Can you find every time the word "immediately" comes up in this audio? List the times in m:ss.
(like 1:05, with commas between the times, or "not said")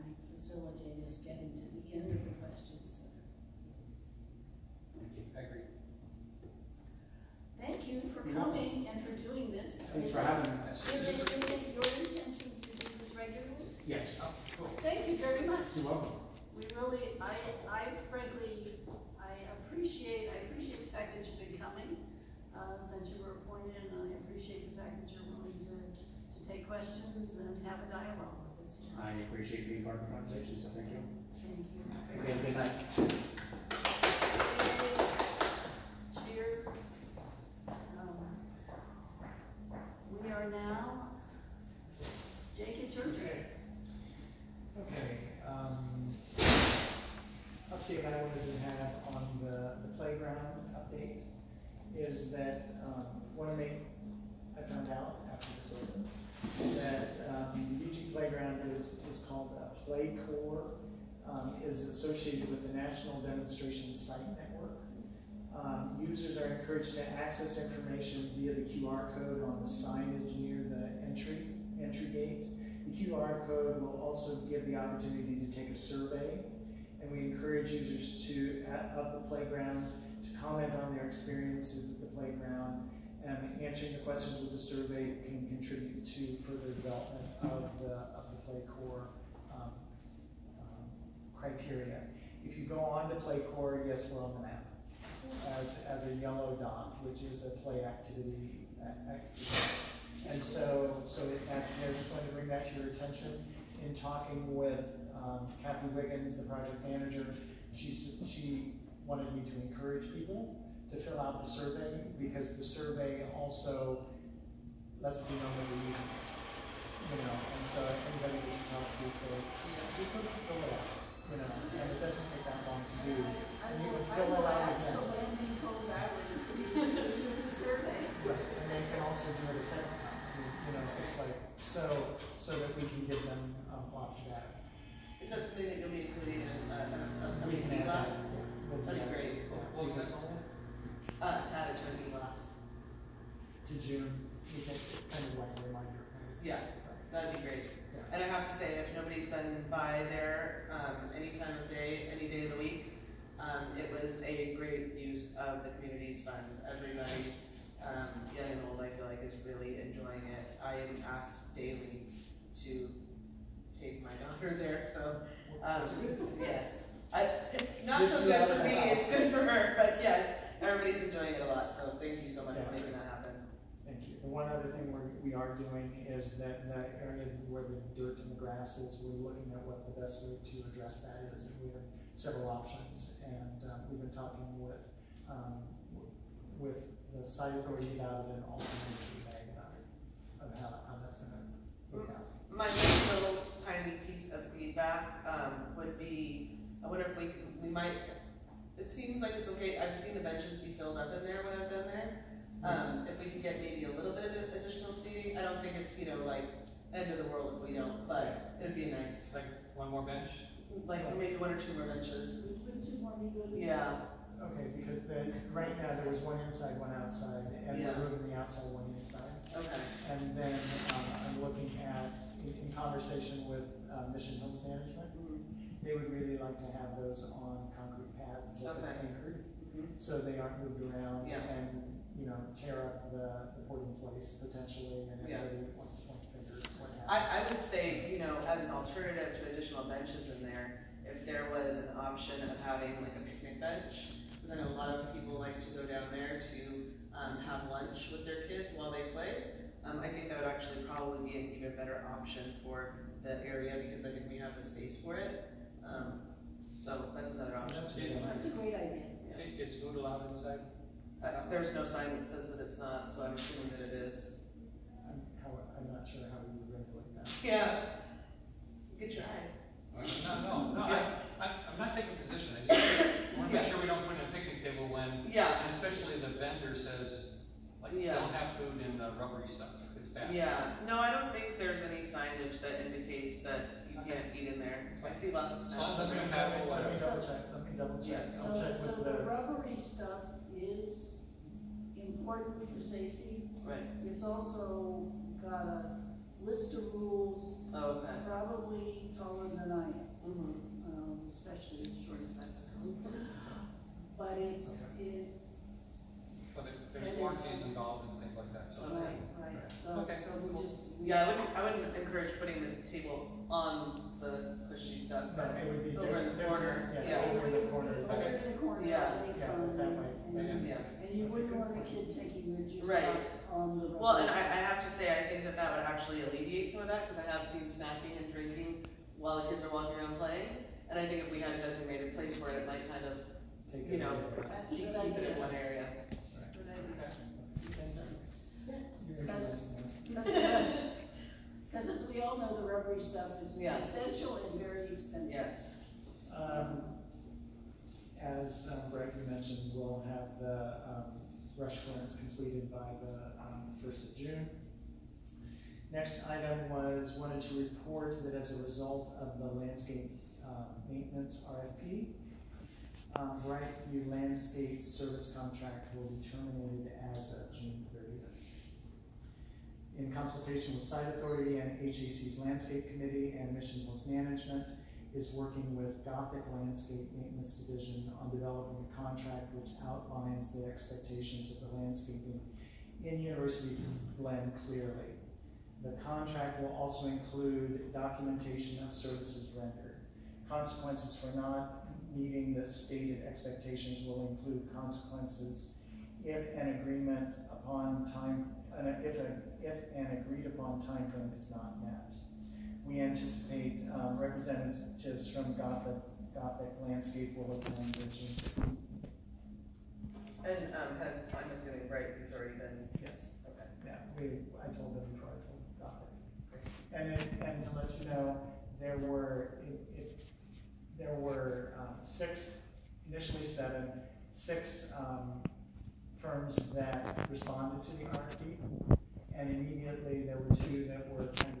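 7:09.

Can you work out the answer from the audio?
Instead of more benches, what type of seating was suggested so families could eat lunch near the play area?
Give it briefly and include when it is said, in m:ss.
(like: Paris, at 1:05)
Picnic bench, at 4:03.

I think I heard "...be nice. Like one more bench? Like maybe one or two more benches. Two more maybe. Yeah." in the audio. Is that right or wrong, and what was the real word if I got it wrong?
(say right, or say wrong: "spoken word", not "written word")
right.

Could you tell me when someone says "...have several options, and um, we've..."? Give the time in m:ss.
3:01.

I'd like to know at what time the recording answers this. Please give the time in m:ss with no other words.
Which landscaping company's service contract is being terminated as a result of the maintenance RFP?
6:03.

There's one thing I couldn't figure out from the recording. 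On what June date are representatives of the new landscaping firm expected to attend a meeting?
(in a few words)
June 16.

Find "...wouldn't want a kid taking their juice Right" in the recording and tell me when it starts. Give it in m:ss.
5:21.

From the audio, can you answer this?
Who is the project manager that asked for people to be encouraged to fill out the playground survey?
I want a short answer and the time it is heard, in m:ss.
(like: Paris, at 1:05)
Kathy Wiggins, at 1:45.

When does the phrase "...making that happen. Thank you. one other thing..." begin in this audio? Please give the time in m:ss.
2:52.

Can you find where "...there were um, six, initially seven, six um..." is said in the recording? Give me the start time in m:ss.
7:00.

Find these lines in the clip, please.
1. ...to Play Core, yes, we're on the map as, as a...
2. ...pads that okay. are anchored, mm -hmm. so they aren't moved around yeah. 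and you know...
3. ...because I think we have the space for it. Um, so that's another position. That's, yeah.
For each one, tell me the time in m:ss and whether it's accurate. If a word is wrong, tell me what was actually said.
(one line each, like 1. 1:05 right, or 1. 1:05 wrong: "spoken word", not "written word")
1. 1:33 right
2. 3:48 right
3. 4:13 wrong: "option", not "position".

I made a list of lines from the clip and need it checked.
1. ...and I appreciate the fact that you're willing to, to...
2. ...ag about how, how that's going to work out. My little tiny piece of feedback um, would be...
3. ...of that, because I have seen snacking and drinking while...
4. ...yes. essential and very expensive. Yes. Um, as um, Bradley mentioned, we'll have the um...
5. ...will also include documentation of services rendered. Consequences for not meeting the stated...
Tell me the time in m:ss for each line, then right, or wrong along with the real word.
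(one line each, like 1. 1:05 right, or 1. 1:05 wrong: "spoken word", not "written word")
1. 0:23 right
2. 3:09 right
3. 5:26 right
4. 5:43 right
5. 6:26 right.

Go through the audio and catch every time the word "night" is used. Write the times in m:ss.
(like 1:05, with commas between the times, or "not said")
0:32.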